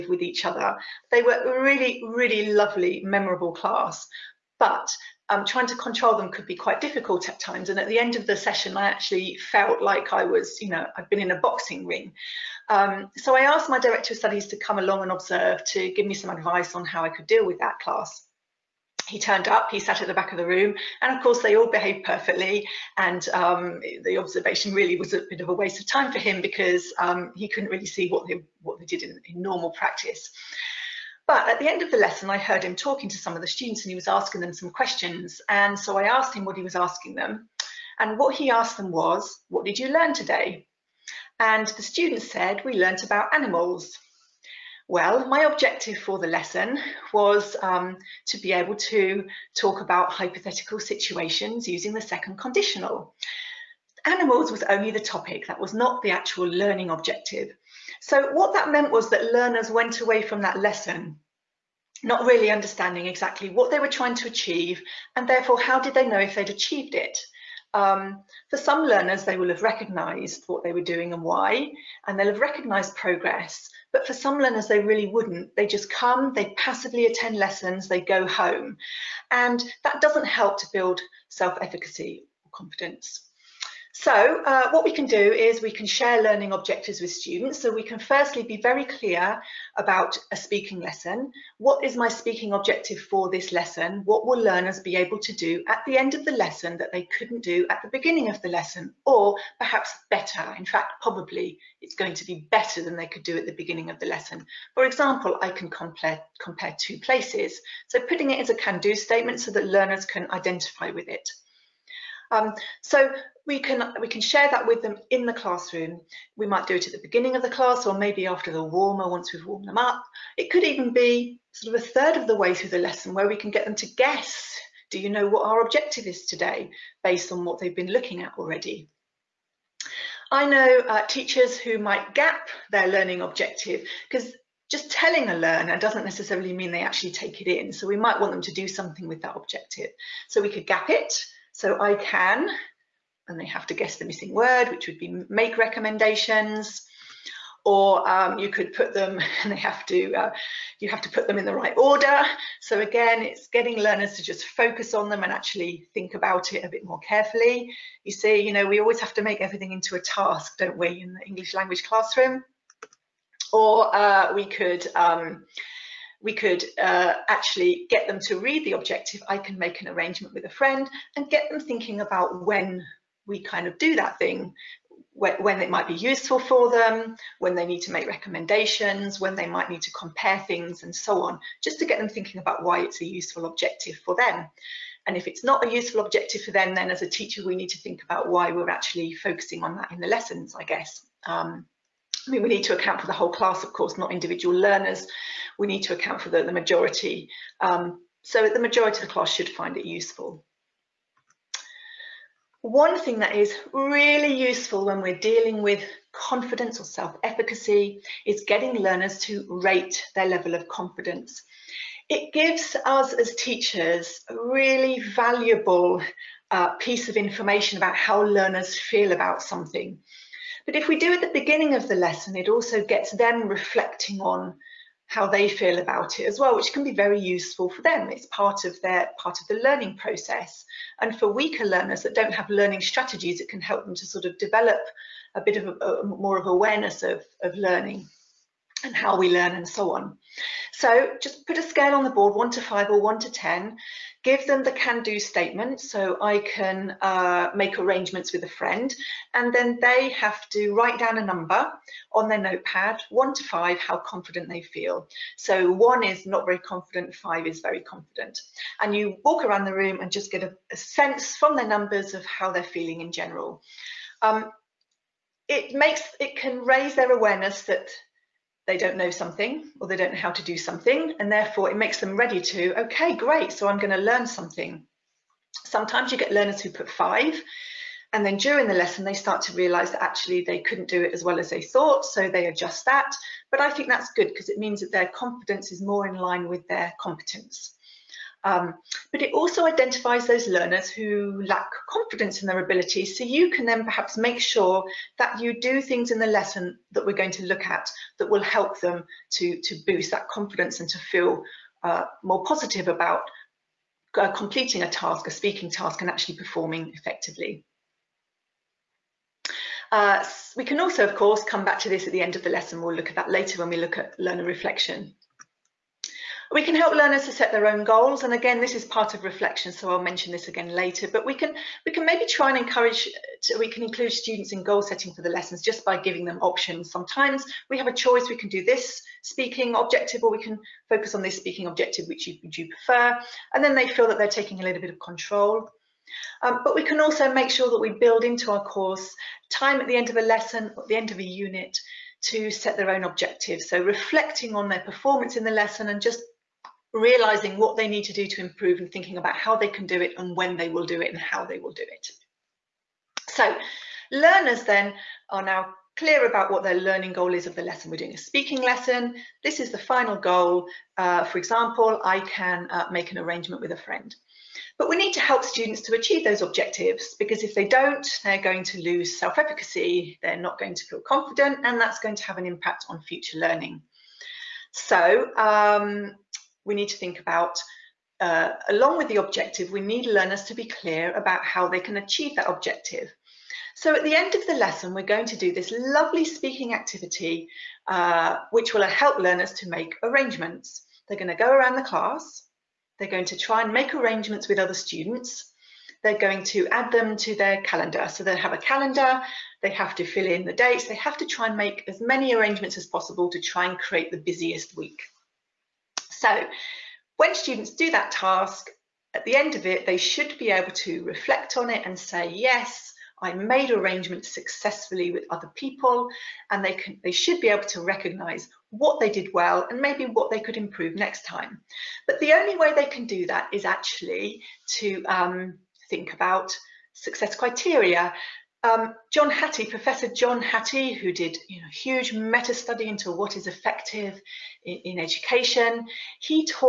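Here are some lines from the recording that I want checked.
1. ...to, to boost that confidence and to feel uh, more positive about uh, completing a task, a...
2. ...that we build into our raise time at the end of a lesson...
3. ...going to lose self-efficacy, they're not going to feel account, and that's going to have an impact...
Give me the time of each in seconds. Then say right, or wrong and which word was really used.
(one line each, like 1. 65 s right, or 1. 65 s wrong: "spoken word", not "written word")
1. 299 s right
2. 337 s wrong: "course", not "raise"
3. 368 s wrong: "confident", not "account".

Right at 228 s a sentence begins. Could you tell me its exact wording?
It's part of their part of the learning process.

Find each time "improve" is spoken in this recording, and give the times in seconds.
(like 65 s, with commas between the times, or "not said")
348 s, 420 s.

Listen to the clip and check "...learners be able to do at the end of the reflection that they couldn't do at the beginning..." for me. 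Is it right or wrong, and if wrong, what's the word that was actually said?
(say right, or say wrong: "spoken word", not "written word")
wrong: "lesson", not "reflection".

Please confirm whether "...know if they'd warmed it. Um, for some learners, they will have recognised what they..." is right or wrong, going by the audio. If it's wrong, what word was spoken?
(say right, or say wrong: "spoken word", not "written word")
wrong: "achieved", not "warmed".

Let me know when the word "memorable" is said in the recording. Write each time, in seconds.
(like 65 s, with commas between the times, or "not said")
3 s.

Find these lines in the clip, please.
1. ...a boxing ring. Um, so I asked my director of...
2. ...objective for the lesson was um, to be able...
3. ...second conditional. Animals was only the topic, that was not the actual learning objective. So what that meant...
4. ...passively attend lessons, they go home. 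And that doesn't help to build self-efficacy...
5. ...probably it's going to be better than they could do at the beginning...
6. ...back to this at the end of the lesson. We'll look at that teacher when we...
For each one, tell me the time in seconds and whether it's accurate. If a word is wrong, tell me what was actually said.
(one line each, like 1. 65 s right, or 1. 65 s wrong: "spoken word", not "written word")
1. 11 s right
2. 45 s right
3. 52 s right
4. 76 s right
5. 101 s right
6. 311 s wrong: "later", not "teacher".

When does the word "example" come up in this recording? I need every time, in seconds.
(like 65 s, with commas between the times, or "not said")
104 s, 361 s.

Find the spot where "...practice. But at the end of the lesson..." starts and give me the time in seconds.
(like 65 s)
29 s.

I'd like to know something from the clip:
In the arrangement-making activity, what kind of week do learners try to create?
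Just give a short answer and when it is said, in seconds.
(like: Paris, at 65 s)
the busiest week, at 404 s.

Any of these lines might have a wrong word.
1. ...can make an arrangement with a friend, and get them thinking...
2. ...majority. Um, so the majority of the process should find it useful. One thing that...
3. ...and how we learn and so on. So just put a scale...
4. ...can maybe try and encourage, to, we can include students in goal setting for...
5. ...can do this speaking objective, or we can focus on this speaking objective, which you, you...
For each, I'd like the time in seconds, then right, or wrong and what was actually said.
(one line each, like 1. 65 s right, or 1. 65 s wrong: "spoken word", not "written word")
1. 169 s right
2. 196 s wrong: "class", not "process"
3. 238 s right
4. 321 s right
5. 328 s right.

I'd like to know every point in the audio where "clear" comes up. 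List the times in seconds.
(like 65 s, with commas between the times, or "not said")
88 s, 355 s, 380 s.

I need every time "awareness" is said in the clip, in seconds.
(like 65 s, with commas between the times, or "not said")
236 s, 267 s.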